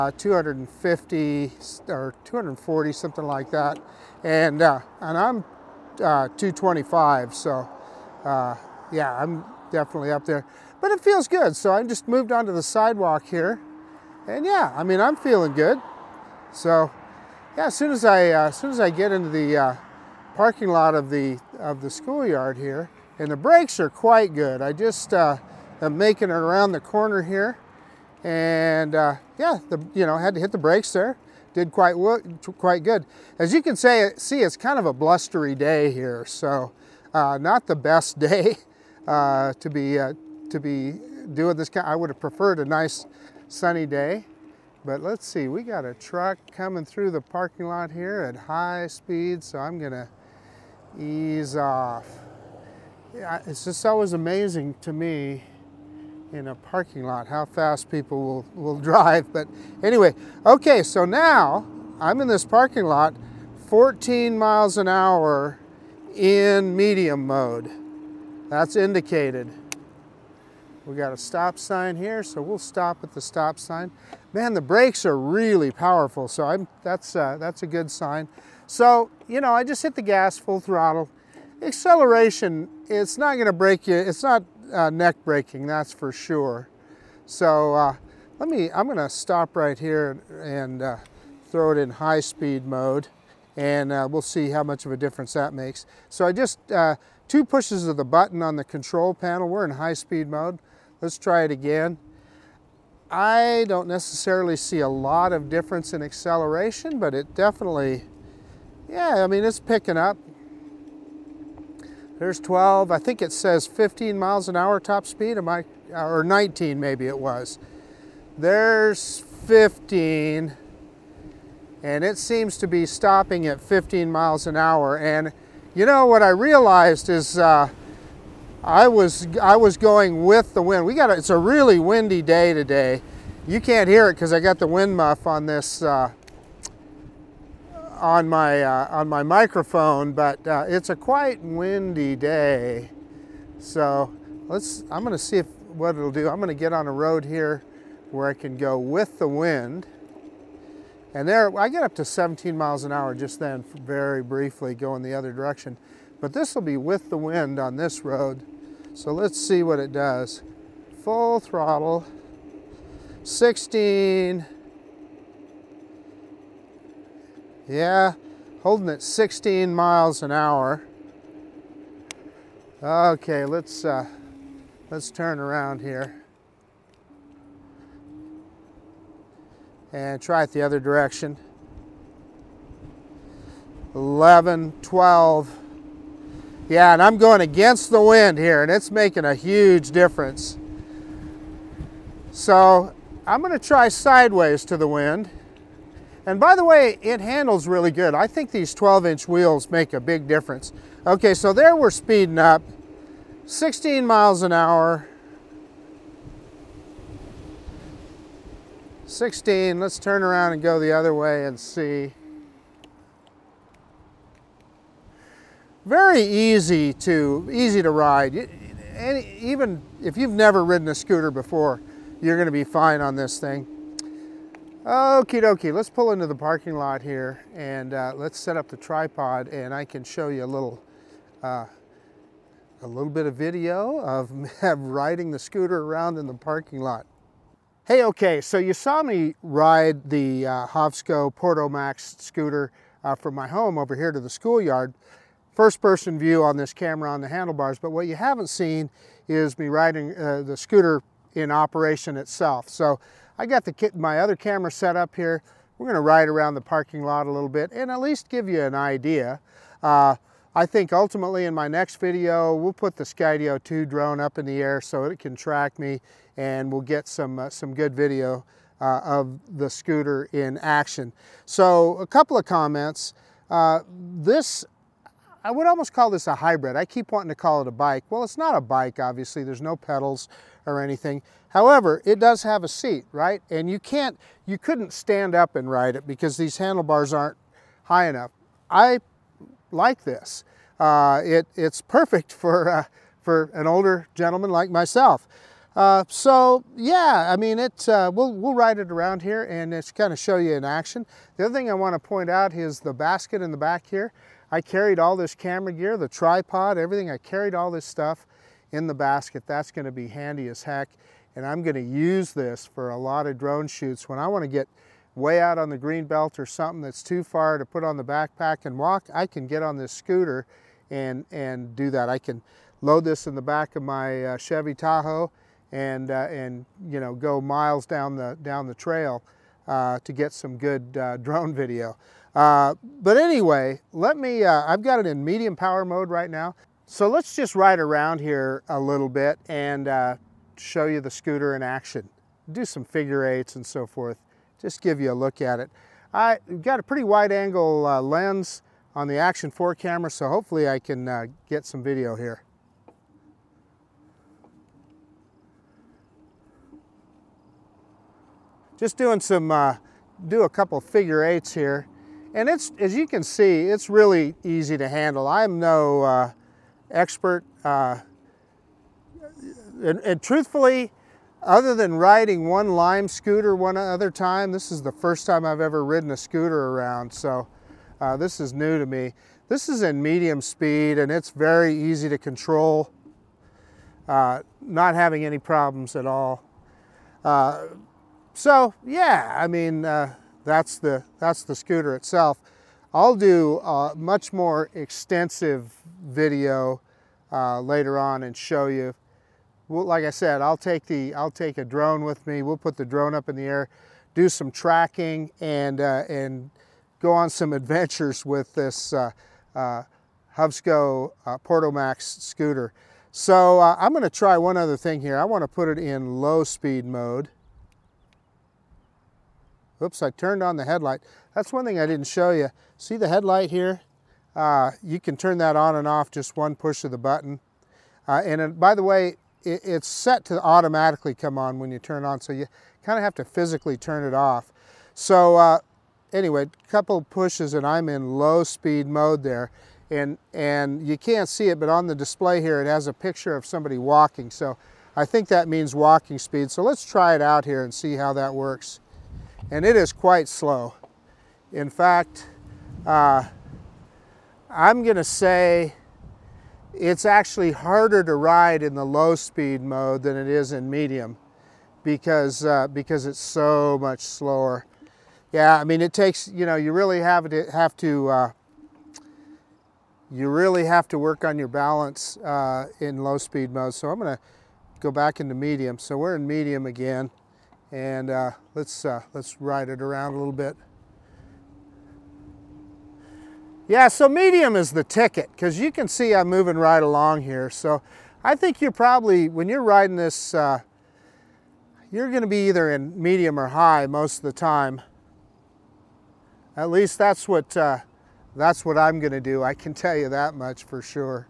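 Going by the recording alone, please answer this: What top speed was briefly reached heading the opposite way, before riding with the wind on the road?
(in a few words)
17 mph.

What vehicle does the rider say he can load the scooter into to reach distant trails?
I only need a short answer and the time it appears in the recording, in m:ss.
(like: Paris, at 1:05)
Chevy Tahoe, at 5:24.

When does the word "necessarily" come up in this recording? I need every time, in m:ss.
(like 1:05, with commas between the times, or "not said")
1:43.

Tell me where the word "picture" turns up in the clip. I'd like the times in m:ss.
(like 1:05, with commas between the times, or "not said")
7:22.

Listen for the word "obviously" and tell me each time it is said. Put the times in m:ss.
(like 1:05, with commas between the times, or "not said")
4:38.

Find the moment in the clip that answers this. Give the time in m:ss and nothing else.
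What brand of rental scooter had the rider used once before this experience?
6:12.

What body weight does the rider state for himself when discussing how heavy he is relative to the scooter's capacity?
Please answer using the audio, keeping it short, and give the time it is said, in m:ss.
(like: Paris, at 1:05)
225, at 0:06.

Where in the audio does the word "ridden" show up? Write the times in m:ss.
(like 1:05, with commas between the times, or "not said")
3:40, 6:15.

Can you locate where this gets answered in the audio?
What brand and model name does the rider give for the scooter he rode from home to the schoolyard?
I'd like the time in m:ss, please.
4:00.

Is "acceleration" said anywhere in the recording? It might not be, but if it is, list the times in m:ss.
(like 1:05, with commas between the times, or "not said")
1:21, 1:46.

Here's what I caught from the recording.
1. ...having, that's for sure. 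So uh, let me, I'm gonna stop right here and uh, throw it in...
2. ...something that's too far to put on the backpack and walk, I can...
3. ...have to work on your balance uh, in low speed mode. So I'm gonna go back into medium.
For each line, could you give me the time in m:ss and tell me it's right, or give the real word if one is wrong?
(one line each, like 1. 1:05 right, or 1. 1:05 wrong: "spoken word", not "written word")
1. 1:25 wrong: "breaking", not "having"
2. 5:16 right
3. 7:50 right.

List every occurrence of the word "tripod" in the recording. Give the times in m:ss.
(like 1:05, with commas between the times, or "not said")
3:48, 5:06.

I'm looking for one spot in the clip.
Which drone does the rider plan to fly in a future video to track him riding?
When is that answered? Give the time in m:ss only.
4:23.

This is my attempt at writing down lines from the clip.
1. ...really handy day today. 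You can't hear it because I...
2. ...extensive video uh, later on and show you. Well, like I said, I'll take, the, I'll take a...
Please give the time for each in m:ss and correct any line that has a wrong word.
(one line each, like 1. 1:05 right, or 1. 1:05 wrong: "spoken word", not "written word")
1. 2:11 wrong: "windy", not "handy"
2. 6:34 right.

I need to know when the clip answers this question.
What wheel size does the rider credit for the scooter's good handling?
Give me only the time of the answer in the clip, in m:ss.
3:18.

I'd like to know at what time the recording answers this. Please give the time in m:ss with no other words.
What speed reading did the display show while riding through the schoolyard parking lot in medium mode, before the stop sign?
1:03.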